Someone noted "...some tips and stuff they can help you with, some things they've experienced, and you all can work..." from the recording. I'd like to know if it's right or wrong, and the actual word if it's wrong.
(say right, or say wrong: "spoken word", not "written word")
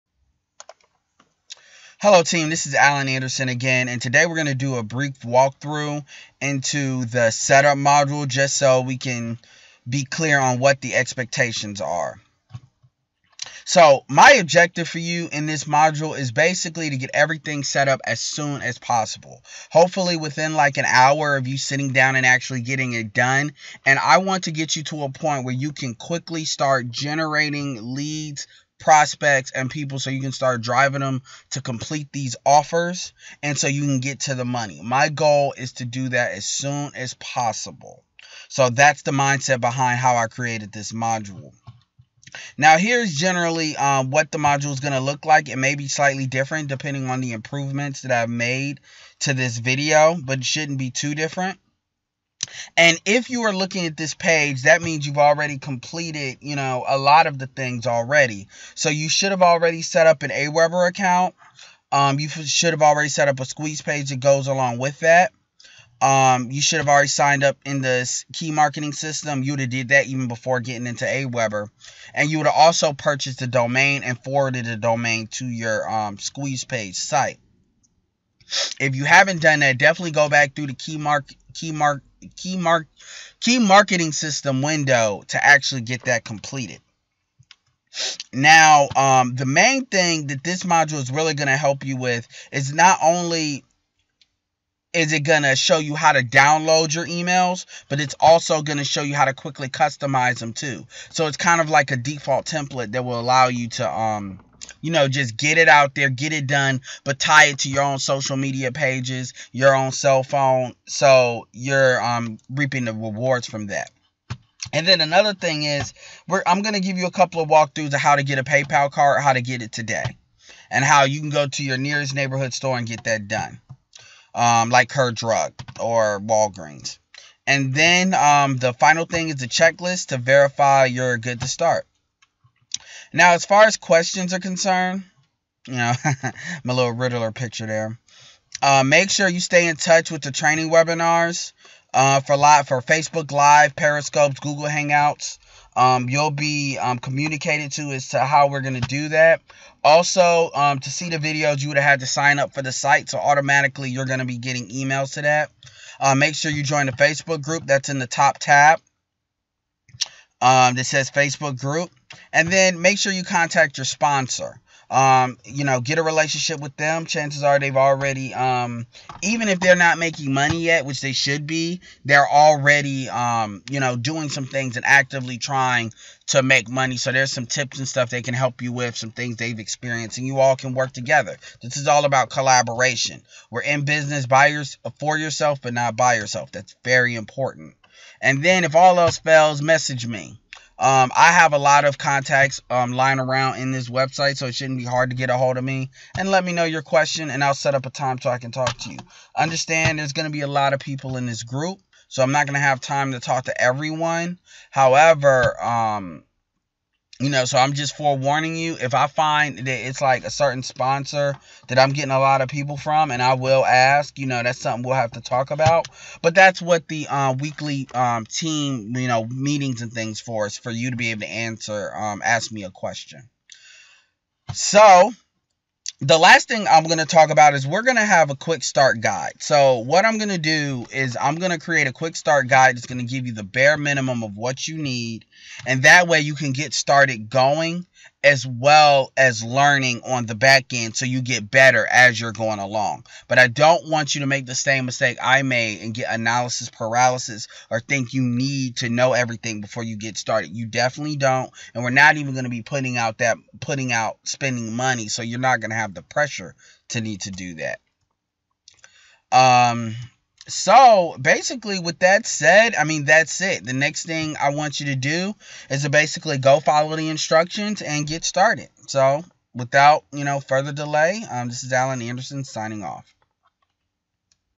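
right.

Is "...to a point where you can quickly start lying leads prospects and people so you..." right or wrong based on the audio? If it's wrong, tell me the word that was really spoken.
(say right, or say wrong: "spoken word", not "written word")
wrong: "generating", not "lying".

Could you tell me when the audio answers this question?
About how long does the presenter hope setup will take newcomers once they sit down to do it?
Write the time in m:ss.
0:20.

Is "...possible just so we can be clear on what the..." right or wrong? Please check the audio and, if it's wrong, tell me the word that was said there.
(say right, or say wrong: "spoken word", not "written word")
wrong: "module", not "possible".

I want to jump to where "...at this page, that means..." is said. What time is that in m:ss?
0:53.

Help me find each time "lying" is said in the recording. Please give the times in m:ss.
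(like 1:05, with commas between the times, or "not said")
3:12.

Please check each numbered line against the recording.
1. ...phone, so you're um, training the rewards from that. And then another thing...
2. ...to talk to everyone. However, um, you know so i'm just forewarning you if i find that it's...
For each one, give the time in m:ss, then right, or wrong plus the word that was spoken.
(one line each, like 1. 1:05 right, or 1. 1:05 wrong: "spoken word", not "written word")
1. 1:50 wrong: "reaping", not "training"
2. 3:23 right.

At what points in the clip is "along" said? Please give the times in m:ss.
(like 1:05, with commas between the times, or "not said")
1:04, 4:02.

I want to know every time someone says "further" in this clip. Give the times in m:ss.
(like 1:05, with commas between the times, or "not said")
4:30.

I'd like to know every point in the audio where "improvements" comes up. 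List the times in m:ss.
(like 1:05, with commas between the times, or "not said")
0:47.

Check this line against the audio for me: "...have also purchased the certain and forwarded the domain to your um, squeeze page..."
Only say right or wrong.
wrong.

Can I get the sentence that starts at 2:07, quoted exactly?
And then um, the final thing is the checklist to verify you're good to start.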